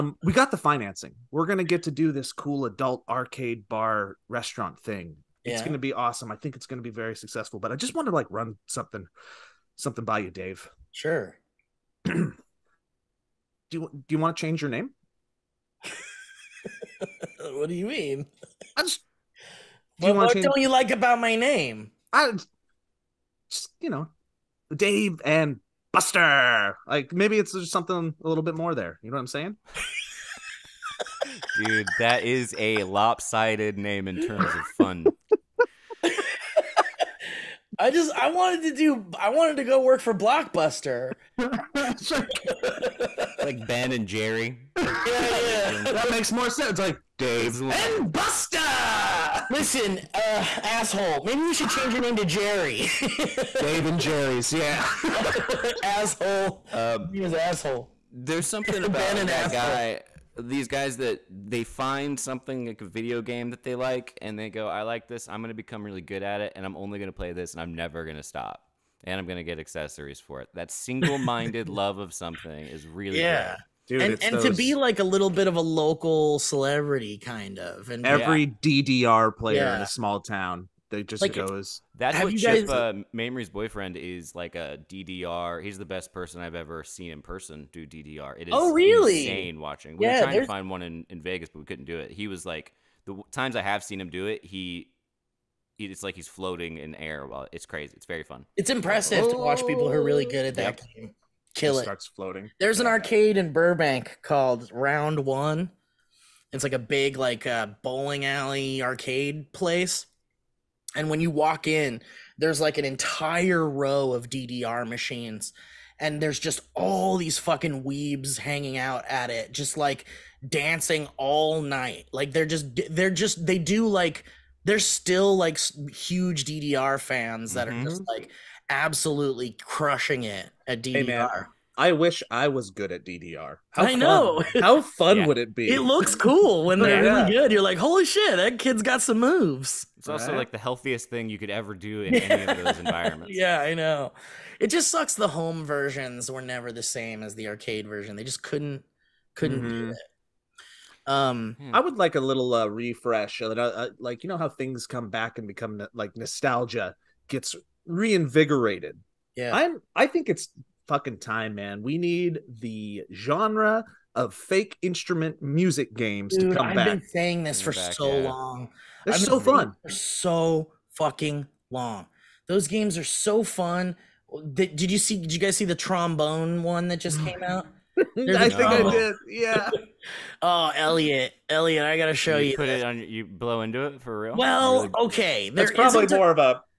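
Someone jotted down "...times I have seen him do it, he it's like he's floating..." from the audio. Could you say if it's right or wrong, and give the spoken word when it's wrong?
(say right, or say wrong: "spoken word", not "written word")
right.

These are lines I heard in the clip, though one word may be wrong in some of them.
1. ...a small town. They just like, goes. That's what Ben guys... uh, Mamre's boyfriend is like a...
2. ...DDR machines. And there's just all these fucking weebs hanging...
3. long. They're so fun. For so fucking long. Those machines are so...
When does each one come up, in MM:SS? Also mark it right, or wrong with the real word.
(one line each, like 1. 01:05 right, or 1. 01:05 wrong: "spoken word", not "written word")
1. 01:19 wrong: "Chip", not "Ben"
2. 01:54 right
3. 02:48 wrong: "games", not "machines".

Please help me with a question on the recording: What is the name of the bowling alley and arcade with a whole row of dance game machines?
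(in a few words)
Round One.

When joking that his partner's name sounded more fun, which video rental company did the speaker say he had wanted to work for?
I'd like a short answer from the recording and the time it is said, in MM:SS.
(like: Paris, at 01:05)
Blockbuster, at 00:40.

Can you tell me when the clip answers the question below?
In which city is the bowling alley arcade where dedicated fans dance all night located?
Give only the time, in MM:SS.
01:43.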